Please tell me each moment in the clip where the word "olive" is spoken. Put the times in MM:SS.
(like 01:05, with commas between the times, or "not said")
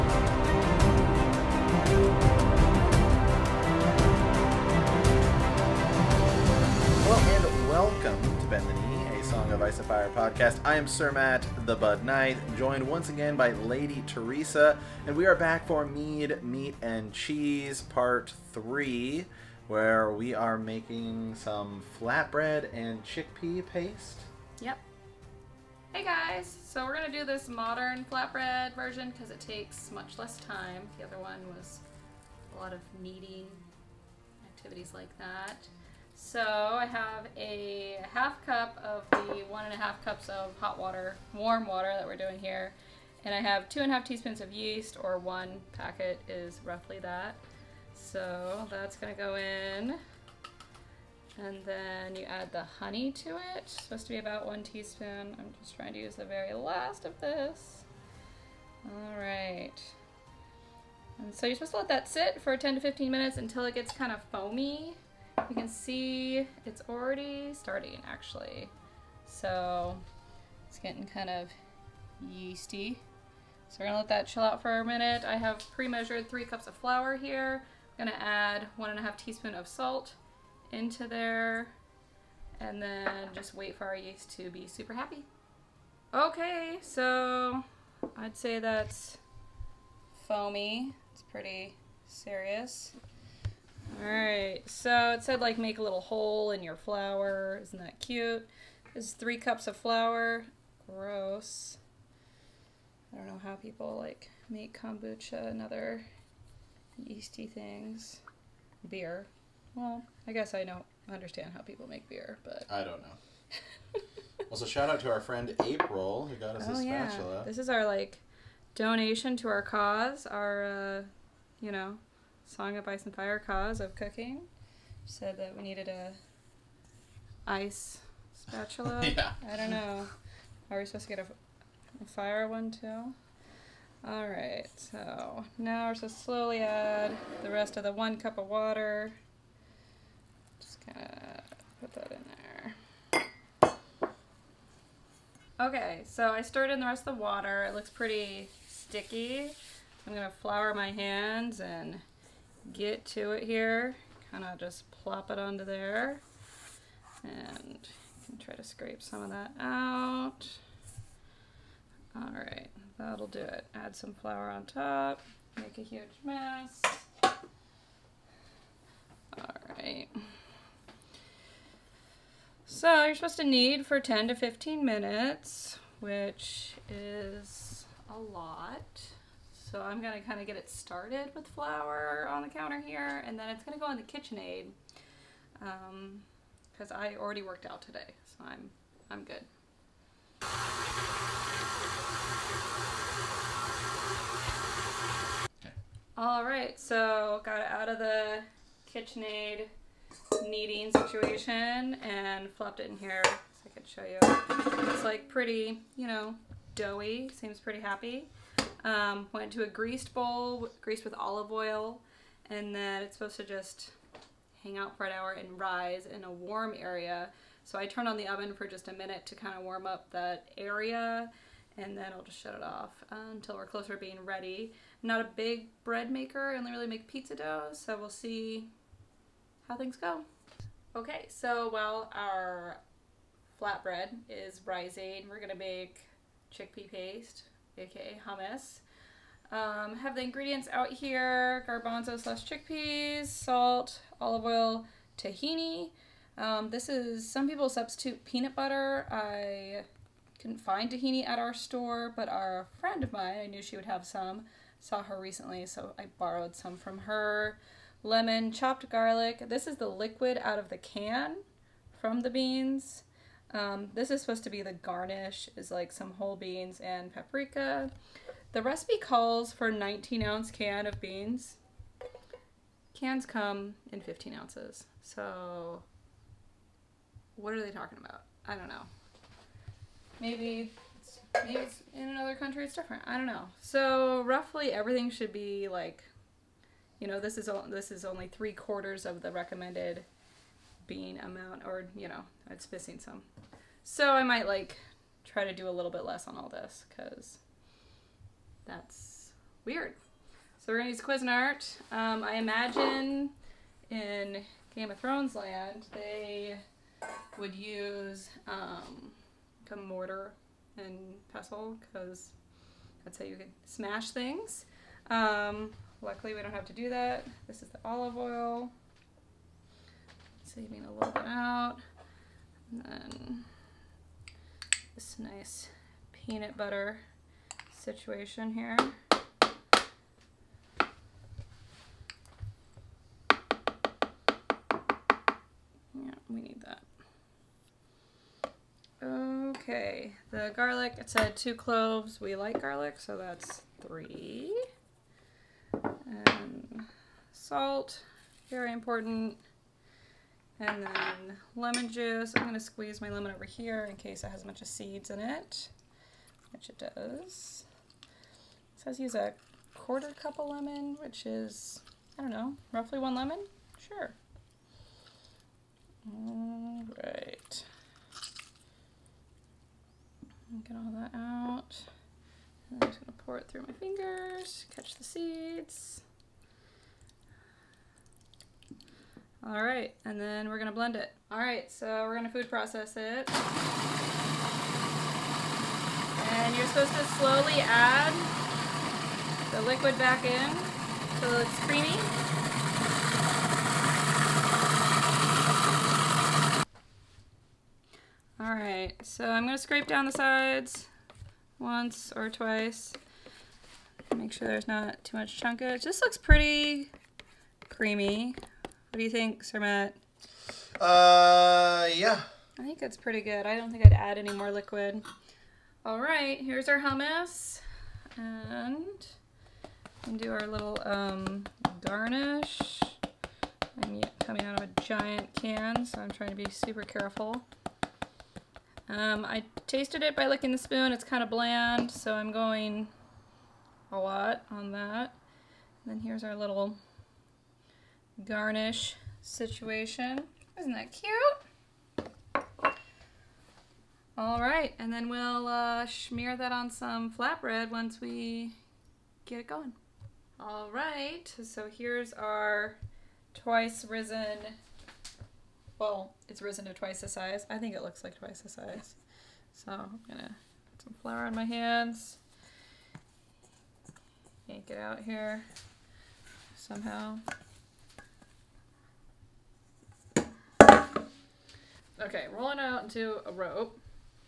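03:31, 04:04, 05:17.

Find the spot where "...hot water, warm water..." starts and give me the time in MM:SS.
00:40.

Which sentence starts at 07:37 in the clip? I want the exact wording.
I think it looks like twice the size.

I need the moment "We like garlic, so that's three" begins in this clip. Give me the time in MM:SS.
05:42.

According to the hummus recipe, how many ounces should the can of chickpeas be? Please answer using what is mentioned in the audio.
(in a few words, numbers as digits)
19 ounces.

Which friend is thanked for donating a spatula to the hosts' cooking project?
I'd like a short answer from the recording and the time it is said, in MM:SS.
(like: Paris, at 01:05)
April, at 01:55.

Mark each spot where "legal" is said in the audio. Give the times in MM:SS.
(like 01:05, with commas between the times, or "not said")
not said.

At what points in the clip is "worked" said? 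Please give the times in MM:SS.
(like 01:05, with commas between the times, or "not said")
03:07.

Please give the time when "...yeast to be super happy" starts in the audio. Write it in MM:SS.
01:23.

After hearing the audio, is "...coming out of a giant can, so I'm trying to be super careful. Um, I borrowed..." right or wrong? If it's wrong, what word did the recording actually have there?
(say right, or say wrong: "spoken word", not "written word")
wrong: "tasted", not "borrowed".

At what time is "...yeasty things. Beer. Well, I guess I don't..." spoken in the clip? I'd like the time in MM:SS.
01:46.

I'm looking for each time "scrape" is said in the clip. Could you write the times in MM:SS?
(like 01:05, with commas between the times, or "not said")
02:38, 06:39.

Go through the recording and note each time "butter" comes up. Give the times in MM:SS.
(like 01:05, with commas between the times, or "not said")
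04:08, 05:26.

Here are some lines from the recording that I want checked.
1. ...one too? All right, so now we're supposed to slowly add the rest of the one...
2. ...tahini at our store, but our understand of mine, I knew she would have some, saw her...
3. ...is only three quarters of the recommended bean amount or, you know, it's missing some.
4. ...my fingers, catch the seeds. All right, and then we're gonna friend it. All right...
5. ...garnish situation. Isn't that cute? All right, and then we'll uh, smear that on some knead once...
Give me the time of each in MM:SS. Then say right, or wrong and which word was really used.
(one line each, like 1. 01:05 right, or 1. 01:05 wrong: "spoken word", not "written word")
1. 02:12 right
2. 04:10 wrong: "friend", not "understand"
3. 04:47 right
4. 06:13 wrong: "blend", not "friend"
5. 07:18 wrong: "flatbread", not "knead".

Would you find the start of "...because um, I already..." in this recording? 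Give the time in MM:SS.
03:06.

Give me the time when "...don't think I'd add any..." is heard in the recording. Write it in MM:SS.
06:53.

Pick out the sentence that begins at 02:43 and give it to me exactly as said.
Add some flour on top, make a huge mess.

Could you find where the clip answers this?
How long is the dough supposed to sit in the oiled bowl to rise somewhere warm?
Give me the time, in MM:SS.
03:35.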